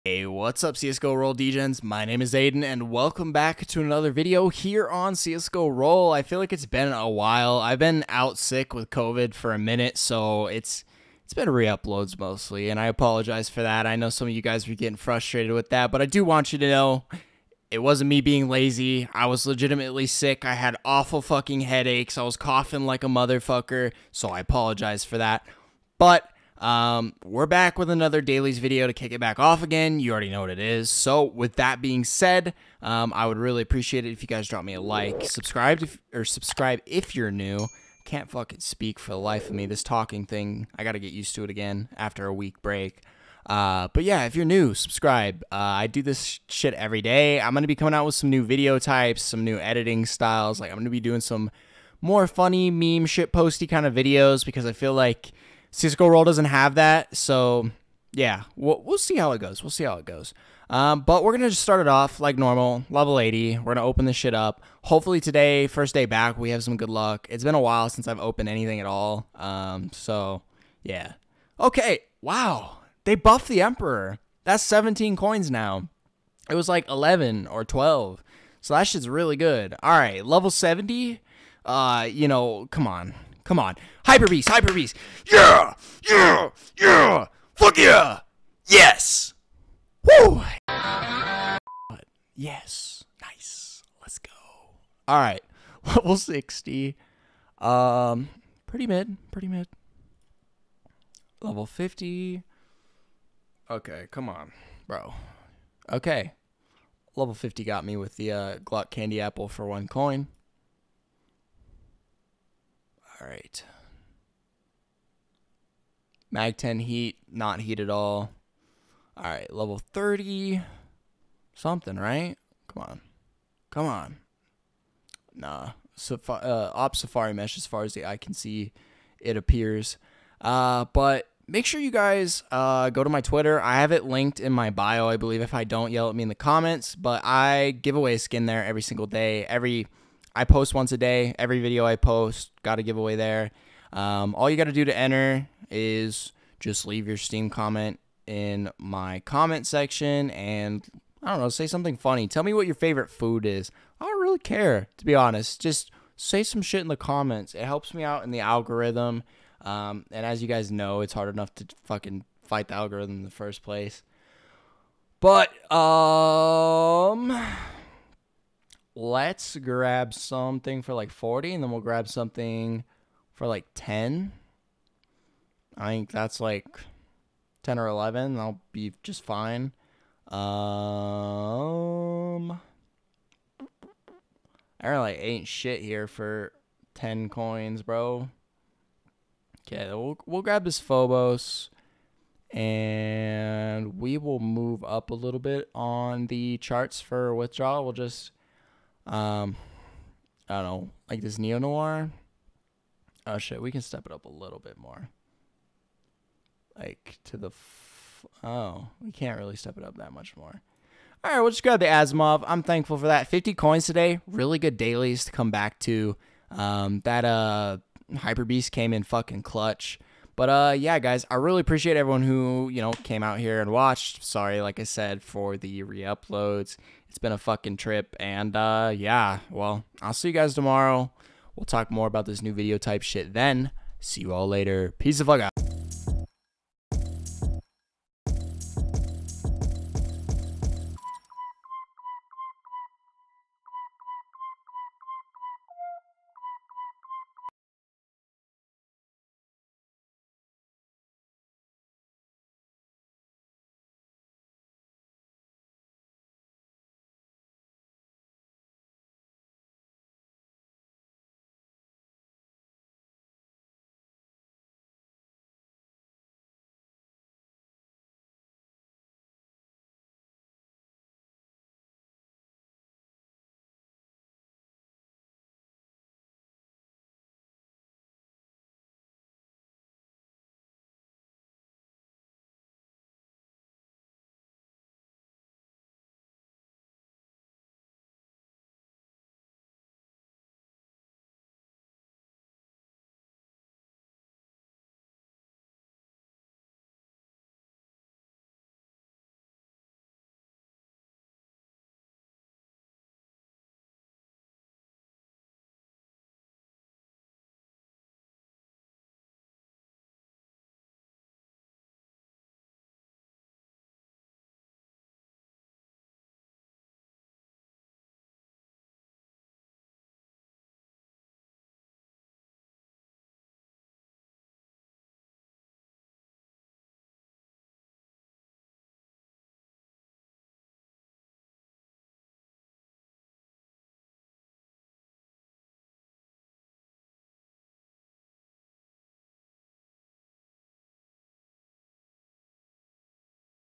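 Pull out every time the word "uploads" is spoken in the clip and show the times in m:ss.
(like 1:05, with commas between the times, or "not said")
0:11, 3:45.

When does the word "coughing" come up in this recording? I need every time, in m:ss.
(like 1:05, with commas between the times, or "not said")
0:22.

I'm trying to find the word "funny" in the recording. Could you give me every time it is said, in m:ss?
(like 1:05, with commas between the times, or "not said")
0:52, 2:31.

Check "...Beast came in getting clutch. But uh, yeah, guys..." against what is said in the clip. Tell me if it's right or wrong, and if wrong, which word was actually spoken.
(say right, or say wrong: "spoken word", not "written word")
wrong: "fucking", not "getting".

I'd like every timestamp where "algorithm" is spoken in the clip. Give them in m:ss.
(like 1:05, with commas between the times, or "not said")
2:38, 2:42.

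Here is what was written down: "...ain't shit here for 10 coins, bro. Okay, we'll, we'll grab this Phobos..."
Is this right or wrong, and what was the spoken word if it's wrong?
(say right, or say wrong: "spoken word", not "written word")
right.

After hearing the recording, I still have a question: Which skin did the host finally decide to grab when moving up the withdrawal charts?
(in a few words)
Asimov.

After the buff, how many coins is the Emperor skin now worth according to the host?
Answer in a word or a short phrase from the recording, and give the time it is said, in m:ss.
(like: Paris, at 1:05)
17, at 1:14.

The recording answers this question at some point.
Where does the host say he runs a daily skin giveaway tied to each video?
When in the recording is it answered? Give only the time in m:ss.
2:13.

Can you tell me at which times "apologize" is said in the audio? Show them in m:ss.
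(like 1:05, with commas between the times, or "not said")
0:12, 0:24.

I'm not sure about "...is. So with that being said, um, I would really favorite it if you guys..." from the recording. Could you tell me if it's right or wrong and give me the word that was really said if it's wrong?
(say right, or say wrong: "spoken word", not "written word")
wrong: "appreciate", not "favorite".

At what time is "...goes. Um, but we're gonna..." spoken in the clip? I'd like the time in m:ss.
1:00.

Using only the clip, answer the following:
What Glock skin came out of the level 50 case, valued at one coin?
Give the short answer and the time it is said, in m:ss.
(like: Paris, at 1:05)
Glock Candy Apple, at 1:48.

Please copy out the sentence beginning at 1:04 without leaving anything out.
Hopefully today, first day back, we have some good luck.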